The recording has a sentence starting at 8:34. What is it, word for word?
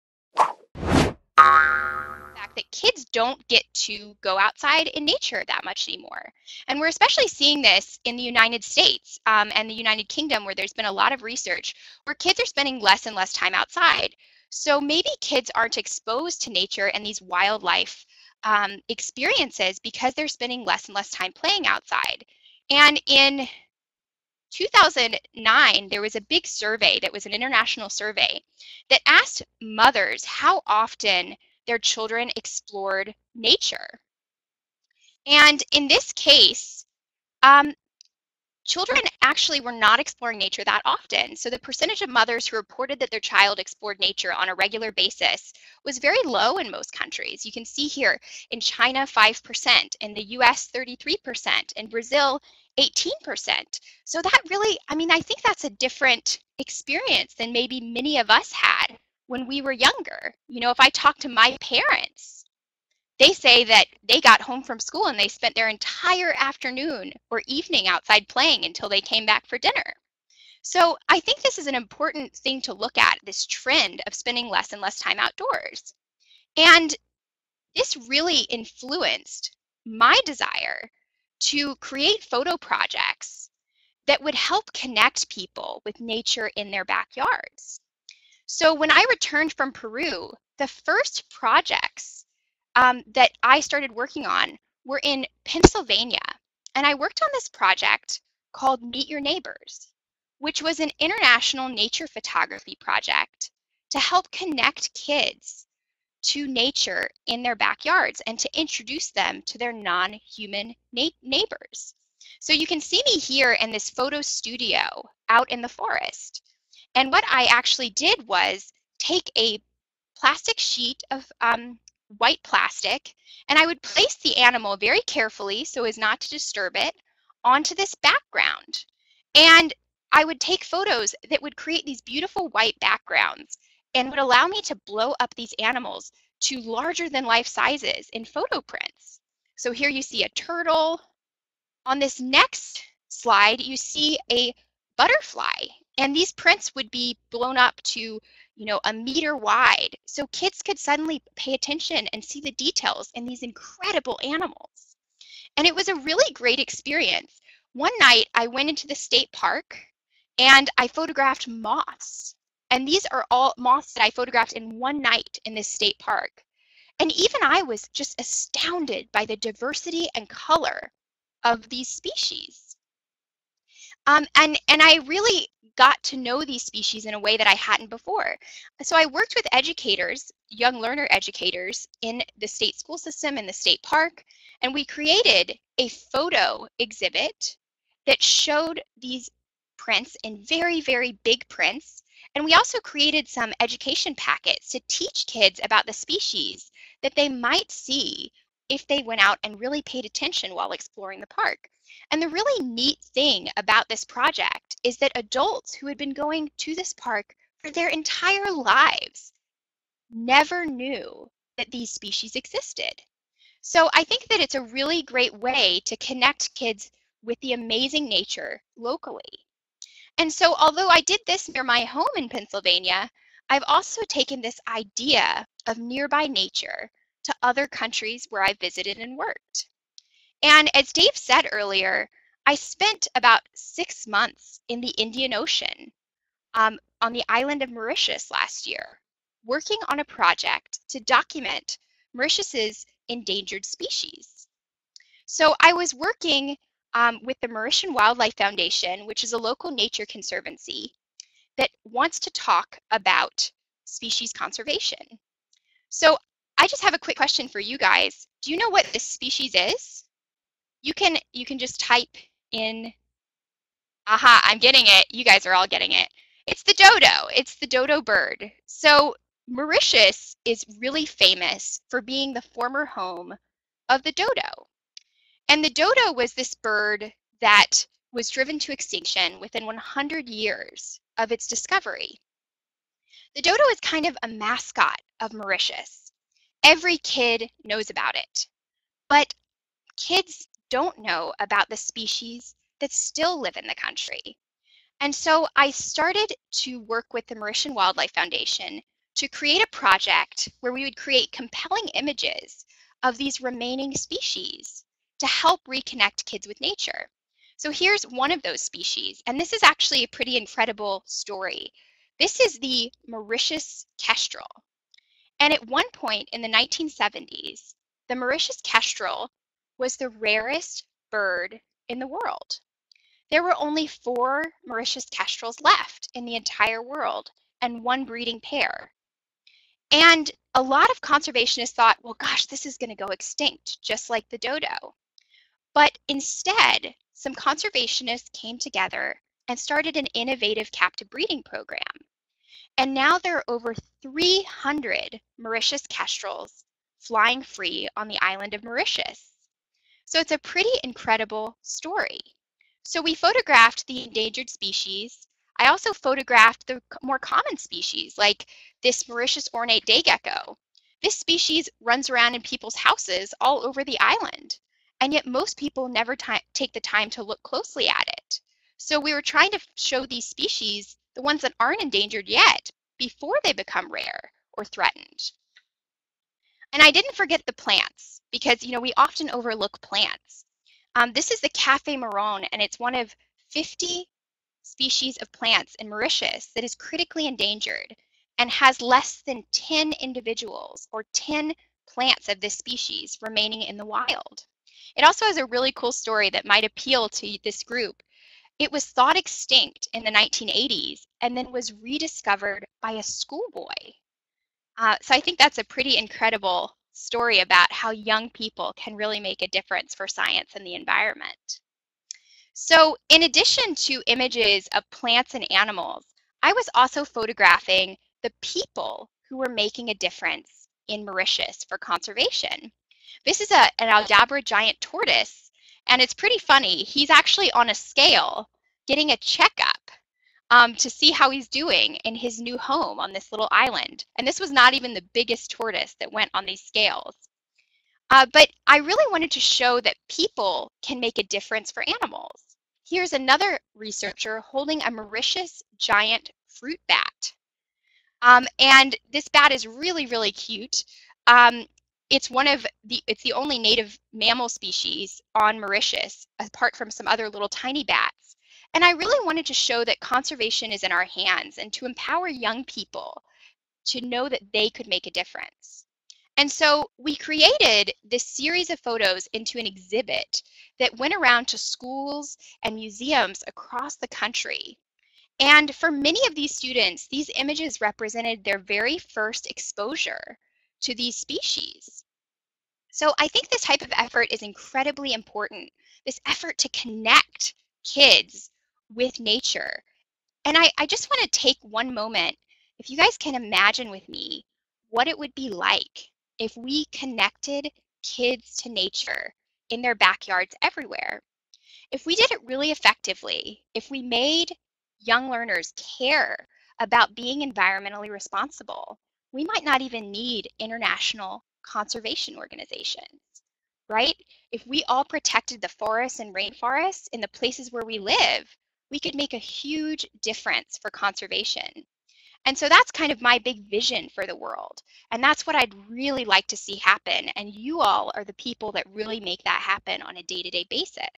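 If we all protected the forests and rainforests in the places where we live, we could make a huge difference for conservation.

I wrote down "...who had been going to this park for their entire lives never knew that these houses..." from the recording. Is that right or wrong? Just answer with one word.
wrong.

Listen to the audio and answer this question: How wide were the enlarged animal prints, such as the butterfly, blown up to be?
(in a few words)
1 meter.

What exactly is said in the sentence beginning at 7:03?
This is a, an Aldabra giant tortoise and it's pretty funny.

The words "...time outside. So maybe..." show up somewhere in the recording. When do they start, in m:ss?
0:13.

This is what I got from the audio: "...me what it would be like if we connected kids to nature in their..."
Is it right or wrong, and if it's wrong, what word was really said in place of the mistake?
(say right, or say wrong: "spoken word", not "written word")
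right.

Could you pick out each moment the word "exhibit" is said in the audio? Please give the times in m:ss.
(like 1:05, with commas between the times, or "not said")
3:06, 7:49.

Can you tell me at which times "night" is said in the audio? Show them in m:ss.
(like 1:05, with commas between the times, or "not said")
2:37, 2:45.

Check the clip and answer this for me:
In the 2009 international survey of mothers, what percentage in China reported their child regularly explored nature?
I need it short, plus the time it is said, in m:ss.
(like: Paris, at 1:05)
5%, at 0:49.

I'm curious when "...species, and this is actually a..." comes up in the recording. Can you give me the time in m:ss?
5:08.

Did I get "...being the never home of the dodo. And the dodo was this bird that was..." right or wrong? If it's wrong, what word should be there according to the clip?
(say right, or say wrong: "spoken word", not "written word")
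wrong: "former", not "never".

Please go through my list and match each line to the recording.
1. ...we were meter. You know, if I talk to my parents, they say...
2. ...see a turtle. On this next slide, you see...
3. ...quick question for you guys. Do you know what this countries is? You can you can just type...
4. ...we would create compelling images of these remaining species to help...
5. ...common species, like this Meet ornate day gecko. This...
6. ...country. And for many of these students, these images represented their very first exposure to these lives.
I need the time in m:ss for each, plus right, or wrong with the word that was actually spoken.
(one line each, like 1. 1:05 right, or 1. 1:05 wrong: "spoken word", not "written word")
1. 0:59 wrong: "younger", not "meter"
2. 2:20 right
3. 4:16 wrong: "species", not "countries"
4. 5:00 right
5. 5:57 wrong: "Mauritius", not "Meet"
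6. 7:54 wrong: "species", not "lives".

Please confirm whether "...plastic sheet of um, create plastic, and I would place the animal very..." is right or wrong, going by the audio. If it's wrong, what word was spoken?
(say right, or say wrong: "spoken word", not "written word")
wrong: "white", not "create".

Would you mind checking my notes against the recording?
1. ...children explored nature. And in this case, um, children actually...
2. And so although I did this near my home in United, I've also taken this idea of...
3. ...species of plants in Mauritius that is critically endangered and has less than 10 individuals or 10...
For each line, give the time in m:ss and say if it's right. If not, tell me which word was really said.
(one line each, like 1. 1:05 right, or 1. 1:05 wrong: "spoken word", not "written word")
1. 0:31 right
2. 3:40 wrong: "Pennsylvania", not "United"
3. 6:24 right.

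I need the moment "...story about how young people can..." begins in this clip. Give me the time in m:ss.
6:46.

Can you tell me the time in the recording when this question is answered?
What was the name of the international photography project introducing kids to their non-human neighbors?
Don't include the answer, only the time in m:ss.
1:38.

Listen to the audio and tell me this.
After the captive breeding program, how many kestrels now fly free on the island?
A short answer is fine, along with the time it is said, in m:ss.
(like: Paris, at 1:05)
over 300, at 5:43.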